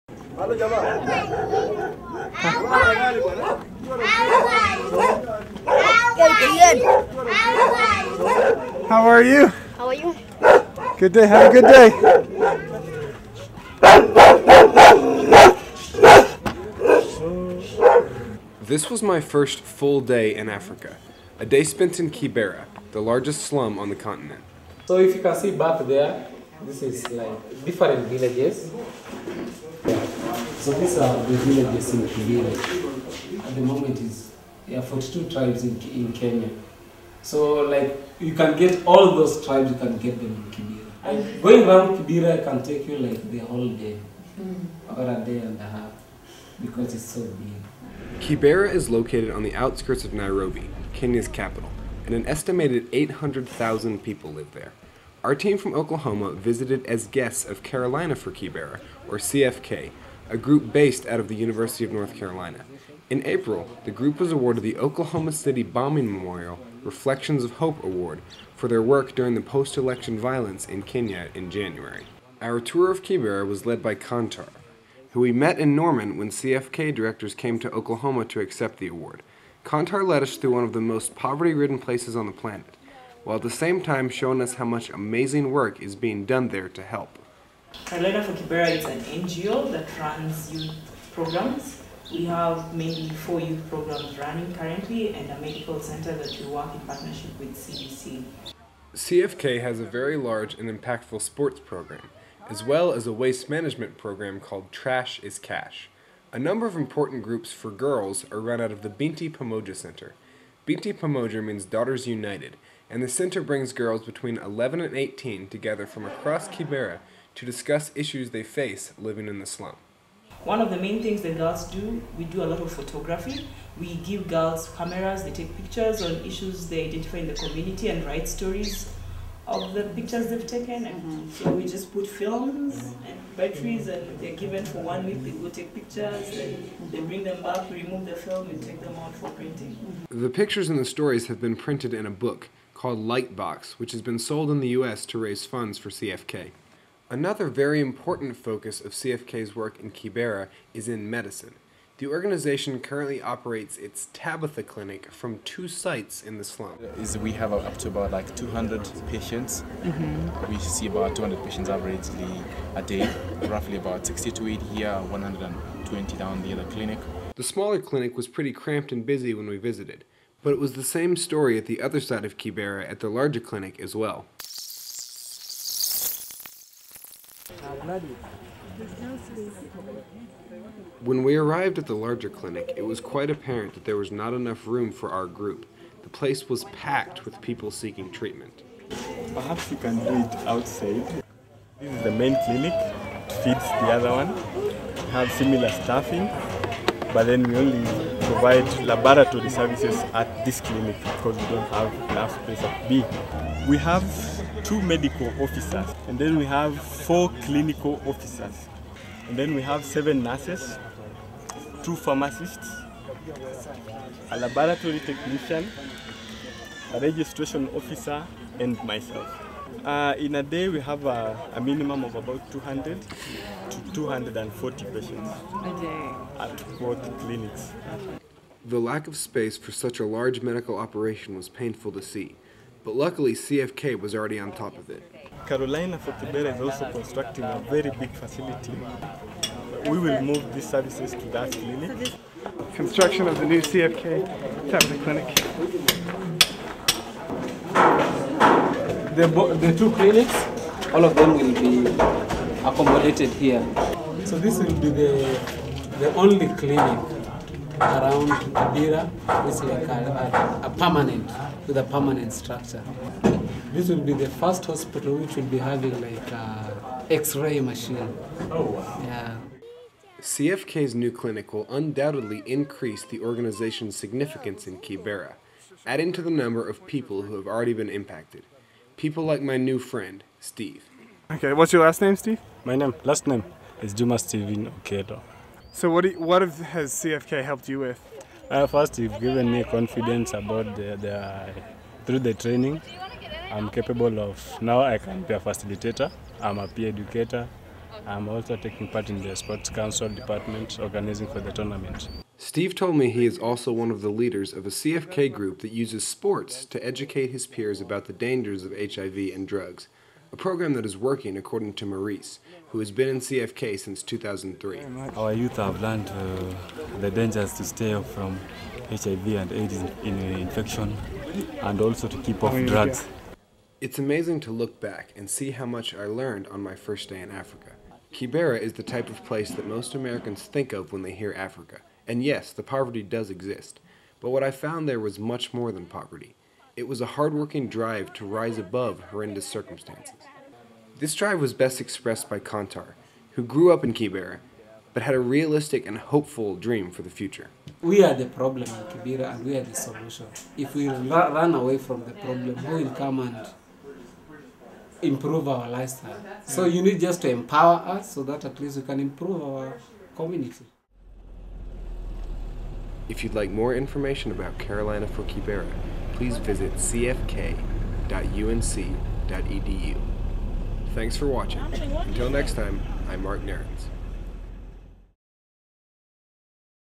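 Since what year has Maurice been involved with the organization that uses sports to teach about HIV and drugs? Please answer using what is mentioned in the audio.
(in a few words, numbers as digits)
2003.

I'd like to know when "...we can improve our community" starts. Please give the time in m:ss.
5:58.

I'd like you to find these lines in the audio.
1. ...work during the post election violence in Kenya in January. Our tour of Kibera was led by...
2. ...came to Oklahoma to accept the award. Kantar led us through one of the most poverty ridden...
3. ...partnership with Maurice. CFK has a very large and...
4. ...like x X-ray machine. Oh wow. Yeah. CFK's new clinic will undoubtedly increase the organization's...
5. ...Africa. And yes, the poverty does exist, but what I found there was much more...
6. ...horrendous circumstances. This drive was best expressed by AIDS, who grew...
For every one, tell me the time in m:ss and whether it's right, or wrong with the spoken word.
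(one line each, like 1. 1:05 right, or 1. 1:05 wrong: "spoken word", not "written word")
1. 1:08 right
2. 1:17 right
3. 1:36 wrong: "CDC", not "Maurice"
4. 4:26 right
5. 5:31 right
6. 5:39 wrong: "Kantar", not "AIDS".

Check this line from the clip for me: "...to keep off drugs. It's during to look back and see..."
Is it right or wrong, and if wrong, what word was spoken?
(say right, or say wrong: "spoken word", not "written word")
wrong: "amazing", not "during".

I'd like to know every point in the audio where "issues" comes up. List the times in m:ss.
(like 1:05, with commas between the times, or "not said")
1:57, 2:06.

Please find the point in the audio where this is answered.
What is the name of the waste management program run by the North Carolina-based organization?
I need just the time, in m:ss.
1:44.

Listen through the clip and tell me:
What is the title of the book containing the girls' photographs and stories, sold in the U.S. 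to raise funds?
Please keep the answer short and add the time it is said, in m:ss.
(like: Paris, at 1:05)
Lightbox, at 2:22.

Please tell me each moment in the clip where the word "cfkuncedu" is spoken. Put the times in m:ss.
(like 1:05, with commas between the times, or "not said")
6:06.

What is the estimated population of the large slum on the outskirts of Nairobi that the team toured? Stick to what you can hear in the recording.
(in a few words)
800,000.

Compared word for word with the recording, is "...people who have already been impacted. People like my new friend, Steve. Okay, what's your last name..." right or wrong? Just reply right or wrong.
right.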